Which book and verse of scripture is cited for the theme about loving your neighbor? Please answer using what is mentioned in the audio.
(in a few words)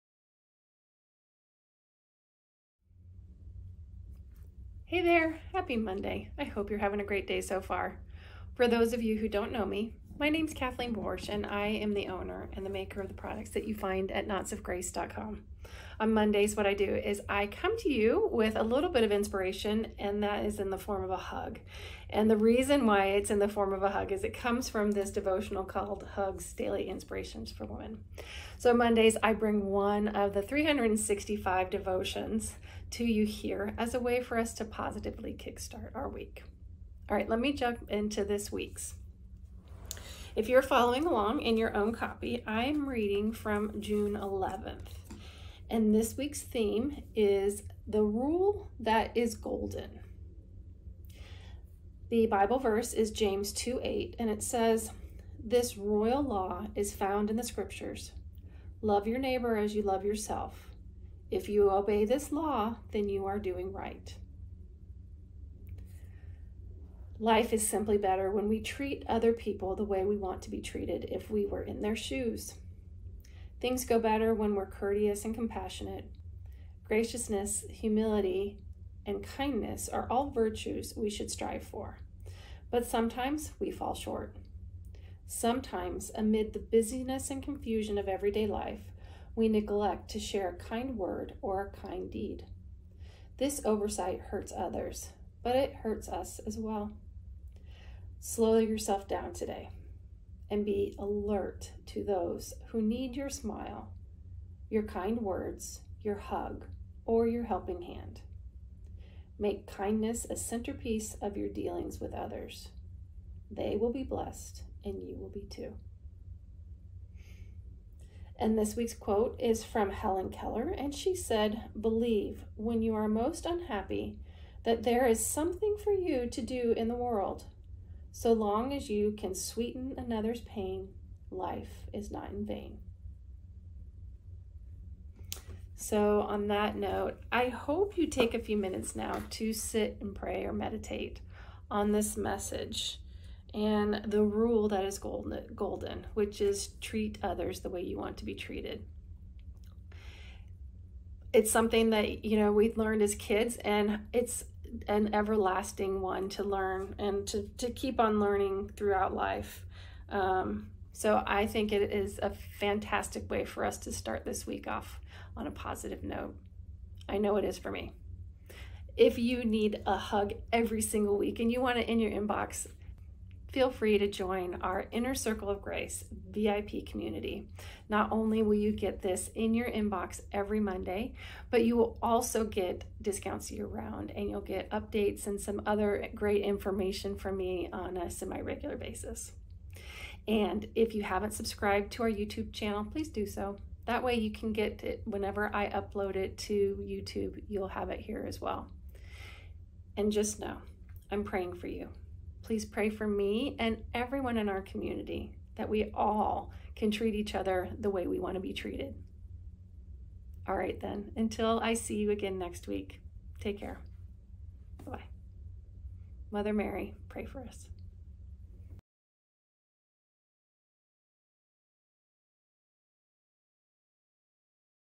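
James 2:8.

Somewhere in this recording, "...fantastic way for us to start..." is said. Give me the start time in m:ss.
2:42.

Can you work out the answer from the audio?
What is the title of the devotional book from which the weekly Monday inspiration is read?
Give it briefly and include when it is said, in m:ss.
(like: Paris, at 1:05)
Hugs Daily Inspirations for Women, at 0:26.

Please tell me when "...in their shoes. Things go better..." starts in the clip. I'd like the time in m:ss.
1:11.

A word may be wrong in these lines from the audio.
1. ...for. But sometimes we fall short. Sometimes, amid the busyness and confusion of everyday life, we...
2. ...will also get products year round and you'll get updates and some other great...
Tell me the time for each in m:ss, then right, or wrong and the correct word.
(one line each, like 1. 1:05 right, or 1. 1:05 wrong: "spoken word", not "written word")
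1. 1:21 right
2. 3:01 wrong: "discounts", not "products".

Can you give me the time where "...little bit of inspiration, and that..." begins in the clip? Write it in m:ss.
0:18.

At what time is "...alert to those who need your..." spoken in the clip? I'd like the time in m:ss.
1:40.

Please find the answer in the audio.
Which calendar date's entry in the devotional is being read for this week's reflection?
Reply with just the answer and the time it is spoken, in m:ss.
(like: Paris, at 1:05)
June 11th, at 0:43.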